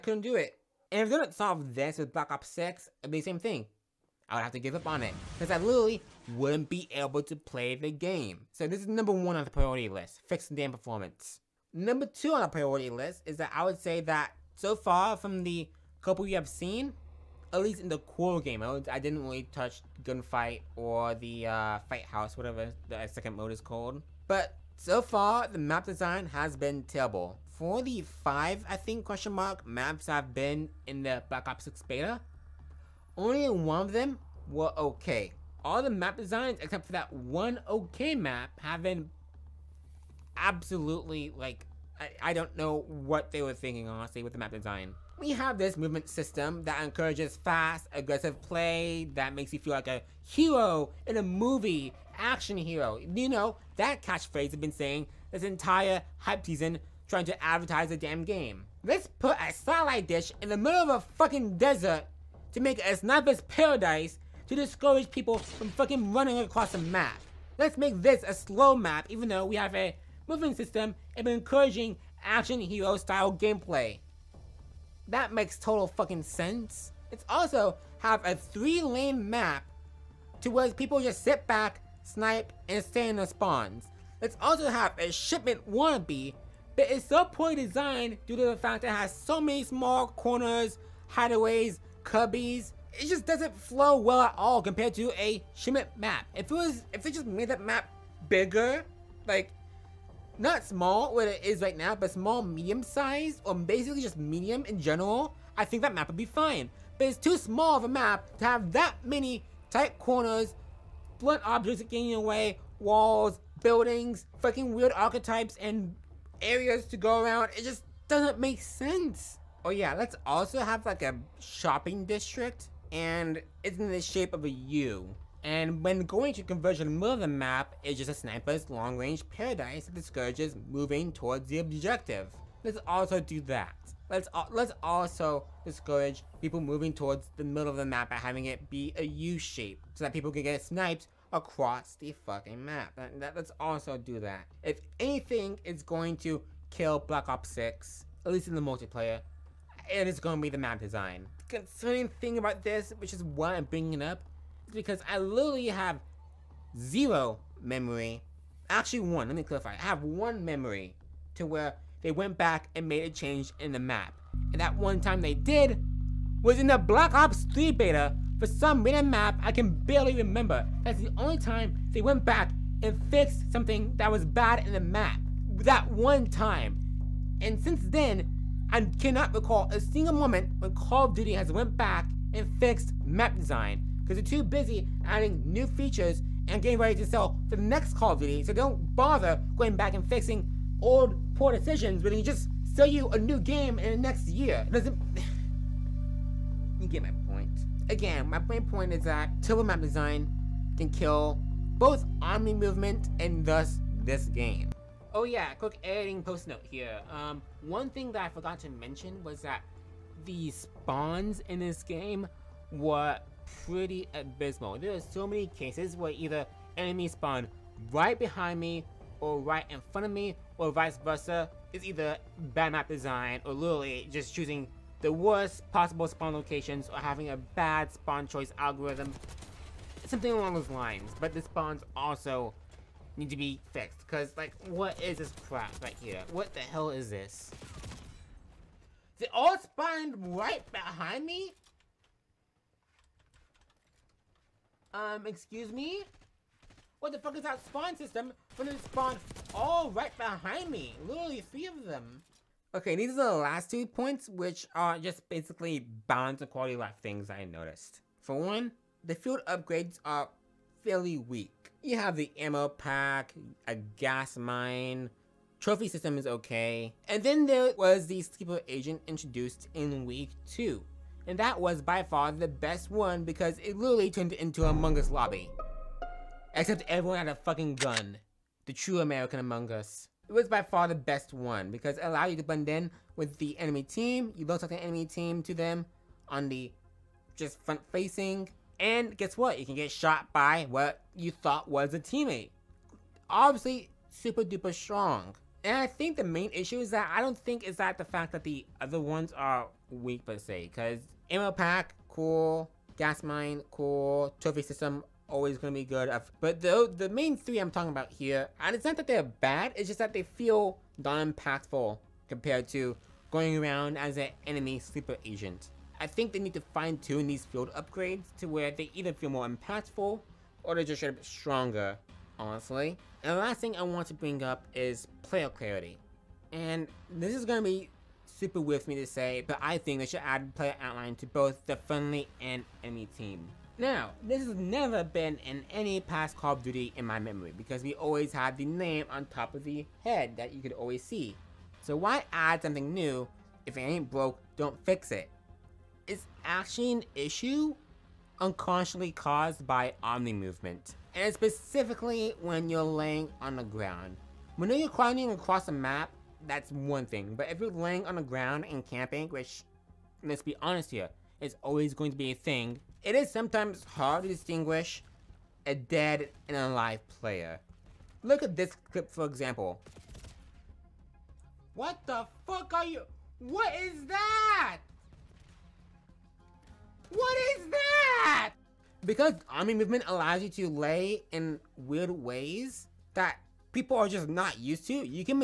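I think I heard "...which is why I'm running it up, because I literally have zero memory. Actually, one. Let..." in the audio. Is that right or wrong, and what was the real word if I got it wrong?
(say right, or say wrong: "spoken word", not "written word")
wrong: "bringing", not "running".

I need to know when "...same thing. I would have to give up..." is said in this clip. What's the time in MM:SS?
00:03.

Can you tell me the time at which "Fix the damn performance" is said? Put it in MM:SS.
00:10.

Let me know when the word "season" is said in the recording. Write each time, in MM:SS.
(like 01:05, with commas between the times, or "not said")
00:56.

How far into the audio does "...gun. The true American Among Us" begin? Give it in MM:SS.
04:37.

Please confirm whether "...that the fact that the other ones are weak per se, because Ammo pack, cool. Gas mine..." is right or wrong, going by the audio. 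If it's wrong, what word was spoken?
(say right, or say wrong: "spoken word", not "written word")
right.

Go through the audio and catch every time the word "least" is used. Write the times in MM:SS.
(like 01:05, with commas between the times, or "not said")
00:17, 02:28.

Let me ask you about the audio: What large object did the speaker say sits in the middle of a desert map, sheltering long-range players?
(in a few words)
A satellite dish.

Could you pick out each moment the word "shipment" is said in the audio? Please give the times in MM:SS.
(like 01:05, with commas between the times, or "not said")
01:25, 01:35.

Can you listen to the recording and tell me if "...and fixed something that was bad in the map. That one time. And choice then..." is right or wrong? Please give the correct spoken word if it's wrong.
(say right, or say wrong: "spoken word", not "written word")
wrong: "since", not "choice".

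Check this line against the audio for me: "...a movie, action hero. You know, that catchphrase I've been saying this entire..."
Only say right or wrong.
right.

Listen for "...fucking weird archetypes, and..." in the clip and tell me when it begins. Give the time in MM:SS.
01:54.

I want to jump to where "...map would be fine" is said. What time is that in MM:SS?
01:45.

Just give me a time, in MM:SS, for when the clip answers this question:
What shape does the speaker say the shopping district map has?
02:19.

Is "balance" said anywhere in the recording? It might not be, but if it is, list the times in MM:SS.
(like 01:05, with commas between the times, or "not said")
04:16.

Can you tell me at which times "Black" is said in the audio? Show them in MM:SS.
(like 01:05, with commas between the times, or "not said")
00:02, 00:31, 02:27, 02:46.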